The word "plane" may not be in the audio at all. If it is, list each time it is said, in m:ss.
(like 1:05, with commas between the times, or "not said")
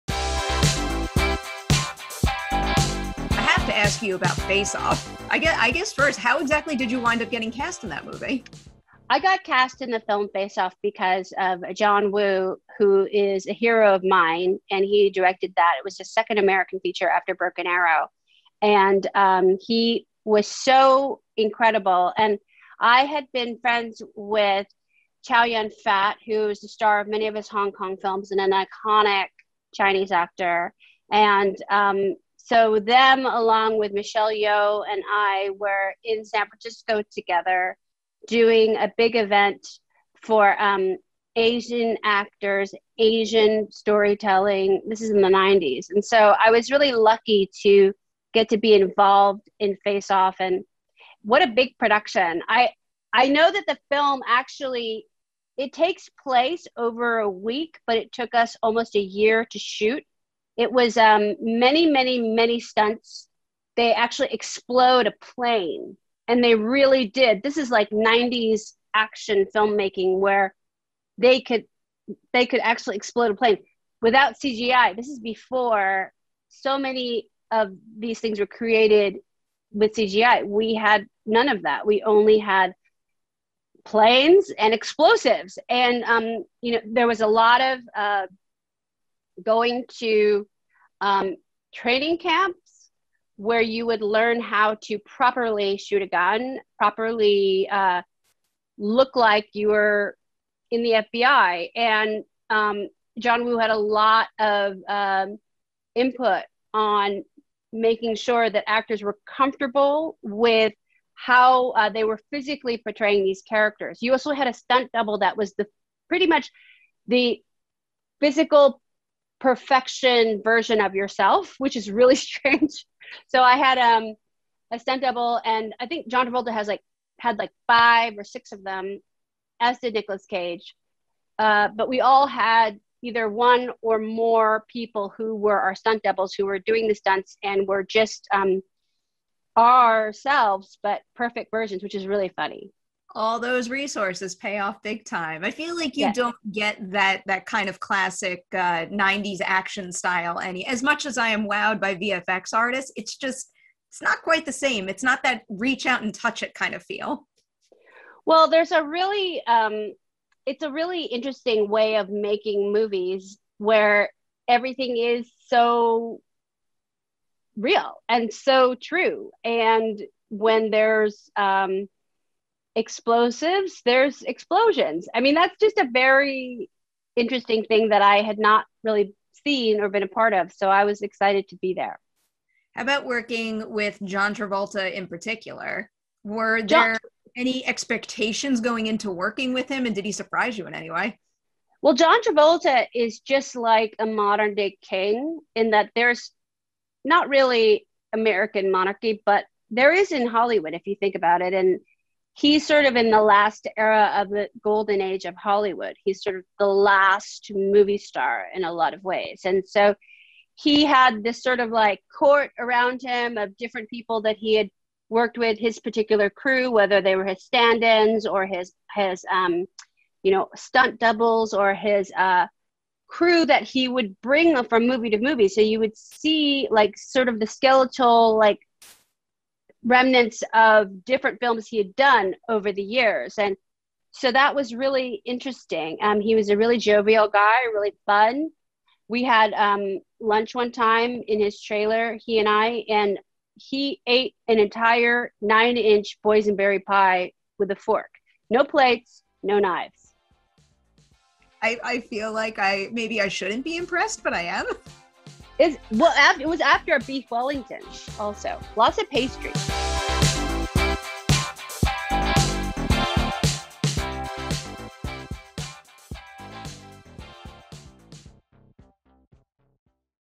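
1:05, 1:13, 1:23.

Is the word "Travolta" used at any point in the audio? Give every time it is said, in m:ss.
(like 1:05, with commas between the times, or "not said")
2:06, 3:04, 3:12.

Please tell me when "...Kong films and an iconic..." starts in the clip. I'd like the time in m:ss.
0:27.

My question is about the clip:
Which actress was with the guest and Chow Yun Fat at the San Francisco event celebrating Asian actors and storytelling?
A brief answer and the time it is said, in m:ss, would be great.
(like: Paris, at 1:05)
Michelle Yeoh, at 0:33.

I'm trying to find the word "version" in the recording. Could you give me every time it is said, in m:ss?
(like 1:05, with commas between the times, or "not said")
2:00, 2:21.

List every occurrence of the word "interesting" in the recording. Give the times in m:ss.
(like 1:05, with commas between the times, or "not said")
2:41, 2:57, 3:55.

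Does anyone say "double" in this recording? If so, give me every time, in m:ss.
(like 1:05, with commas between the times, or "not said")
1:54, 2:05, 2:16, 3:40.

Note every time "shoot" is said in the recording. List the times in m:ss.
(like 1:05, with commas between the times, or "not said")
0:59, 1:35.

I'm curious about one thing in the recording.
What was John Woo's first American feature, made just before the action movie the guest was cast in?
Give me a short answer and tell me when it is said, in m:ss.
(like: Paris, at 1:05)
Broken Arrow, at 0:17.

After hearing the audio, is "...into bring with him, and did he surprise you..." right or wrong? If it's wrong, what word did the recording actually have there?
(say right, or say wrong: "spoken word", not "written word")
wrong: "working", not "bring".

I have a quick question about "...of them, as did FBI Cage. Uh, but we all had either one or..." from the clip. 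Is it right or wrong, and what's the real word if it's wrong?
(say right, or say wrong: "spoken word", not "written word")
wrong: "Nicolas", not "FBI".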